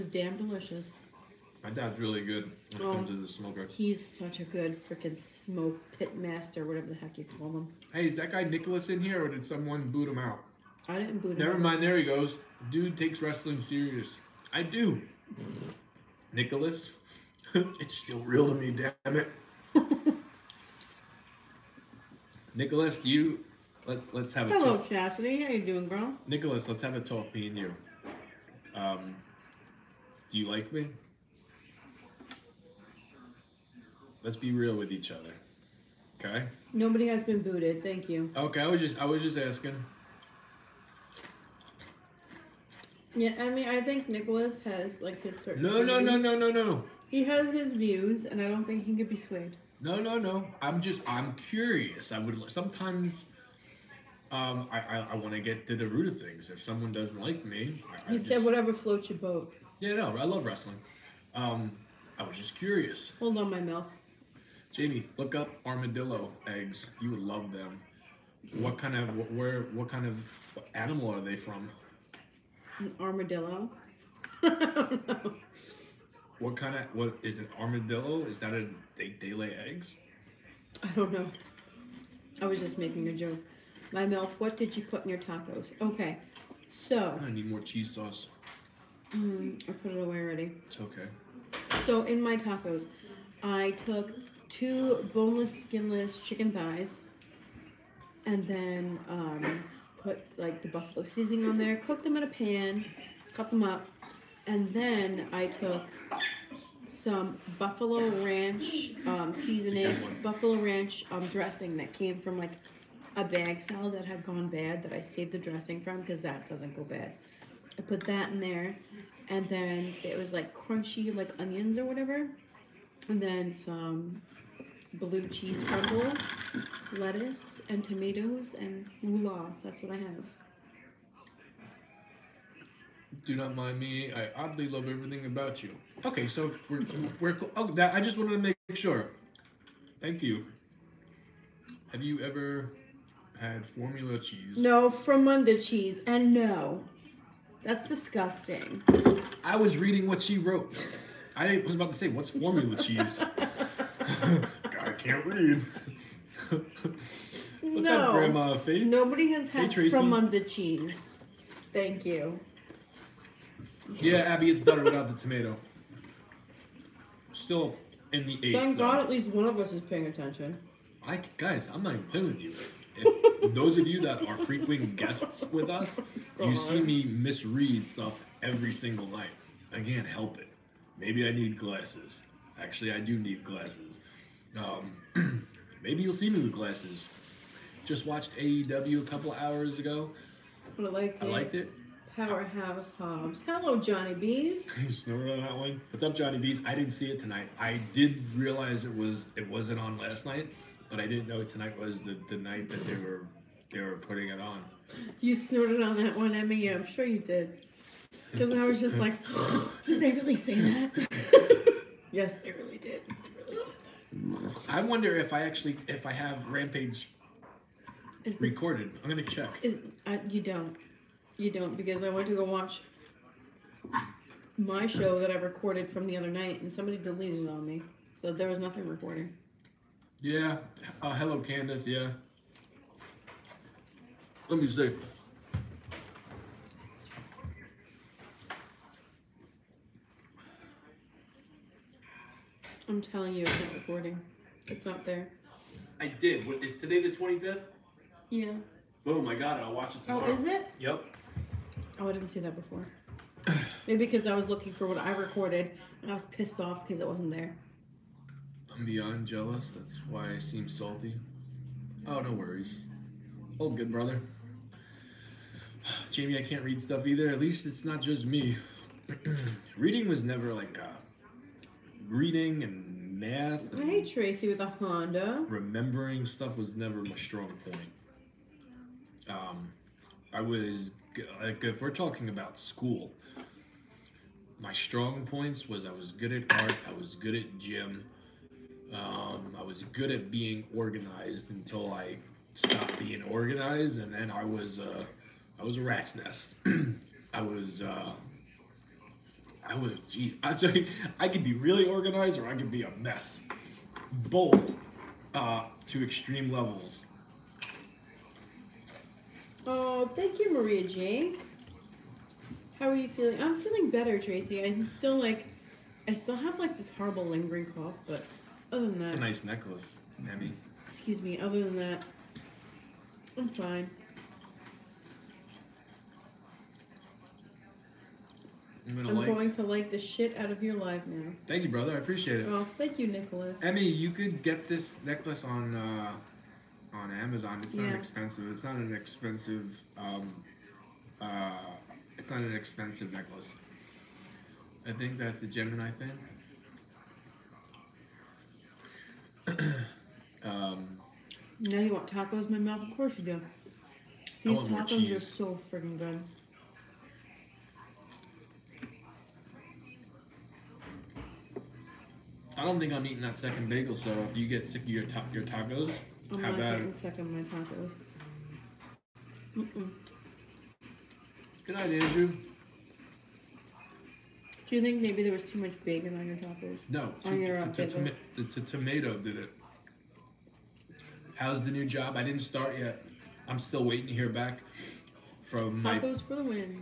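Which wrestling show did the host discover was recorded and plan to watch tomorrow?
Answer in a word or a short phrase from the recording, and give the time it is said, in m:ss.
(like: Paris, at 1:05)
Rampage, at 3:36.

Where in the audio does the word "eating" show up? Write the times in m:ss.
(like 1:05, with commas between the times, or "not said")
6:03.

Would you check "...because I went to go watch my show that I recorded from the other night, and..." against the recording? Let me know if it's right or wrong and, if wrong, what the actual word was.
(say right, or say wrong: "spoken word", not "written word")
right.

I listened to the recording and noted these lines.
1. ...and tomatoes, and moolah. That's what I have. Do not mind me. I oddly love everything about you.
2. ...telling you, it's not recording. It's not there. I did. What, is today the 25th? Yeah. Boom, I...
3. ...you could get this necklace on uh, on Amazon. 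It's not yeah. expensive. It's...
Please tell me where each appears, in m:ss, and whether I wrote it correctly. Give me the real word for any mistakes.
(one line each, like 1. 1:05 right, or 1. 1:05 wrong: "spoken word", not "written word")
1. 2:07 right
2. 4:03 right
3. 5:33 right.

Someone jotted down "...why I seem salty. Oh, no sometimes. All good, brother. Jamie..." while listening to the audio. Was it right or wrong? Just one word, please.
wrong.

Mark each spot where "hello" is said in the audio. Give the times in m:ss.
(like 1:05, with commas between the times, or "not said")
0:24, 3:13, 3:51.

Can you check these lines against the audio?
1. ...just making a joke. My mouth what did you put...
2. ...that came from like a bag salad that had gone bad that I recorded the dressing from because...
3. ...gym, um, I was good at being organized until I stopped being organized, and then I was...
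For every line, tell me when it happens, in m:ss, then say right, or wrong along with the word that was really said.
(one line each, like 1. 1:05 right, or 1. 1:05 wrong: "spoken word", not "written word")
1. 1:22 right
2. 1:51 wrong: "saved", not "recorded"
3. 4:47 right.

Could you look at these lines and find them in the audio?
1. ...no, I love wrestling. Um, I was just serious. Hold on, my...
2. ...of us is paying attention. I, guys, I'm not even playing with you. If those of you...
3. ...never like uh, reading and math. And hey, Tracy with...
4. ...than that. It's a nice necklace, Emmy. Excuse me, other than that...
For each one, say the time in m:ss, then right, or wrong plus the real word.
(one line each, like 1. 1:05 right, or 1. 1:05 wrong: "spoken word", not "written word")
1. 0:59 wrong: "curious", not "serious"
2. 2:49 right
3. 4:30 right
4. 5:18 right.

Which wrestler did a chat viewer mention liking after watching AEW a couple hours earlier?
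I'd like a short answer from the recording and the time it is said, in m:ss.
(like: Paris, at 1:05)
Powerhouse Hobbs, at 3:12.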